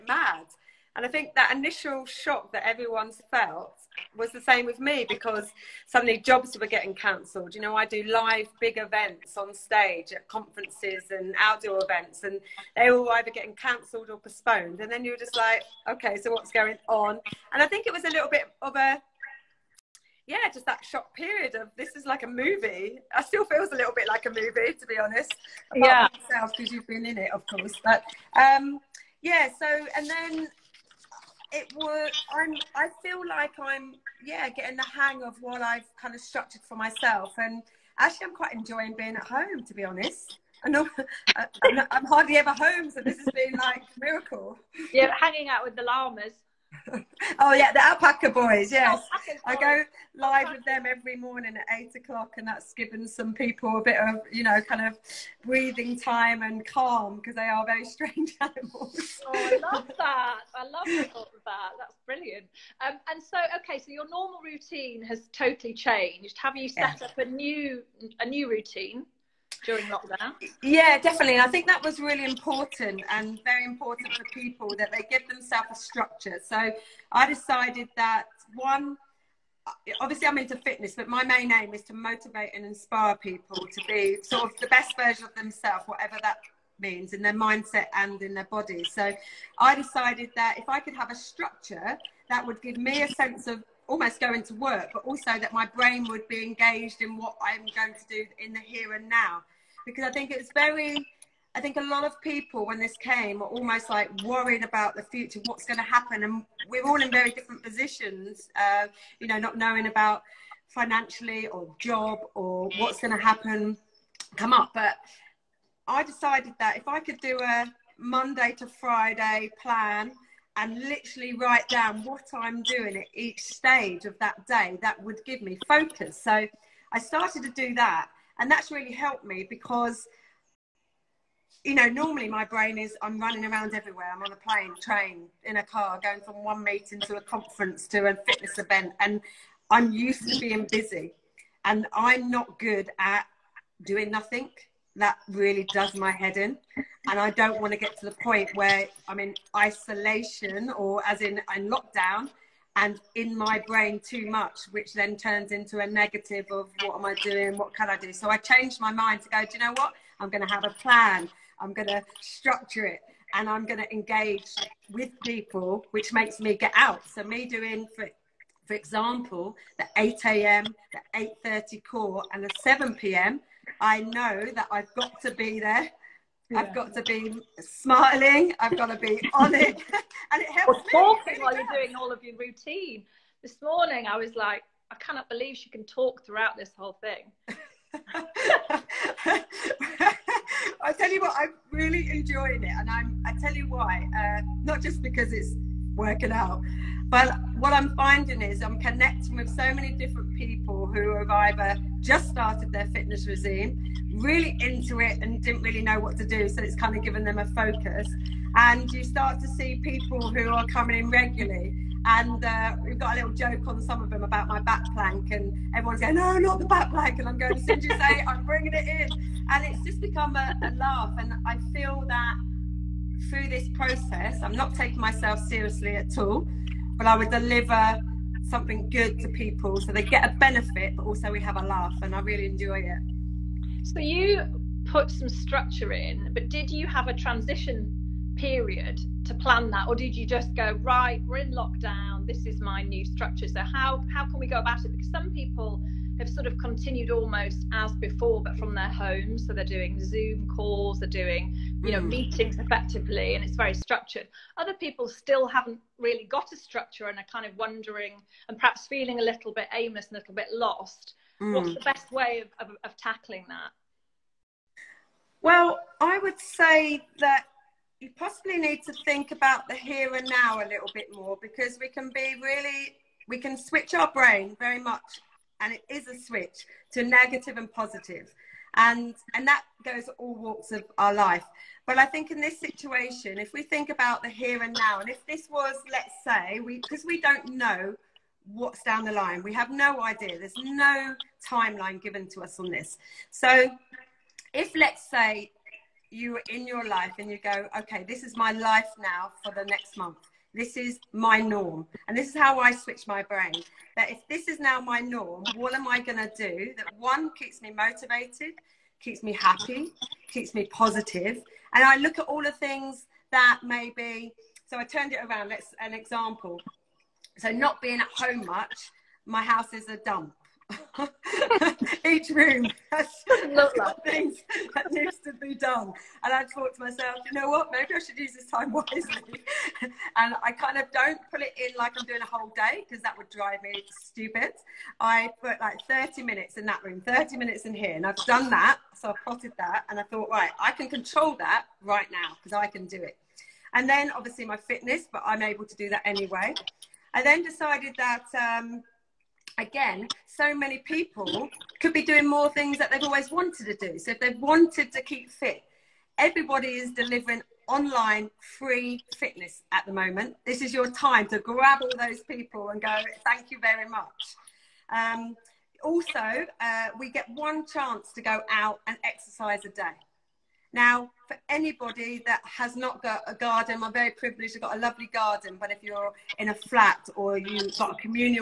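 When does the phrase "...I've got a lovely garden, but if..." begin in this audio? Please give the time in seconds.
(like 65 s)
374 s.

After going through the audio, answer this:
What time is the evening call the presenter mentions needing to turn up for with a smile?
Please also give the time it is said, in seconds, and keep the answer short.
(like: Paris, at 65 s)
7 p.m., at 172 s.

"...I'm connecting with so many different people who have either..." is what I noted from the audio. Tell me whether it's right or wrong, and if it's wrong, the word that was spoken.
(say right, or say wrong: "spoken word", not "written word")
right.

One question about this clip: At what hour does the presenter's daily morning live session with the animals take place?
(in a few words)
8 o'clock.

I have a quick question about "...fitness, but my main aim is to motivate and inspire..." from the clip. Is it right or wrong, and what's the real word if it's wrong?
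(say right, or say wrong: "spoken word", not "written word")
right.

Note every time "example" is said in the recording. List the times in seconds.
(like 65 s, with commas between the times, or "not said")
168 s, 315 s.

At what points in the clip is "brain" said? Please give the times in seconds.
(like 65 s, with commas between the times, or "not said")
95 s, 132 s, 153 s, 274 s, 303 s.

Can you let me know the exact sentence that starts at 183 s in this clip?
This morning, I was like, I cannot believe she can talk throughout this whole thing.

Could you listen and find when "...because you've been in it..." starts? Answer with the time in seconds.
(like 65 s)
26 s.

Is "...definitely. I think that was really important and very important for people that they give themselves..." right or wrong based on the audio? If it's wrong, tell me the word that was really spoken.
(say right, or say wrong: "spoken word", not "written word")
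right.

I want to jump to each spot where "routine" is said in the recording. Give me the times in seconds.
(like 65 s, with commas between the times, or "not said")
64 s, 68 s, 182 s.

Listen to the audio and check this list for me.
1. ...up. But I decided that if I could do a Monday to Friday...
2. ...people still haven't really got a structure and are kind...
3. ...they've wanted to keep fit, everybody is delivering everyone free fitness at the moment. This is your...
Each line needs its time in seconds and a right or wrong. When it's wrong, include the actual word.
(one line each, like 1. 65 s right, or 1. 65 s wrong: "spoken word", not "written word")
1. 114 s right
2. 254 s right
3. 354 s wrong: "online", not "everyone".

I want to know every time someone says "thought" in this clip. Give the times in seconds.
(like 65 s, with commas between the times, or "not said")
326 s, 340 s.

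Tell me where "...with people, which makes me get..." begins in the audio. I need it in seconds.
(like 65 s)
164 s.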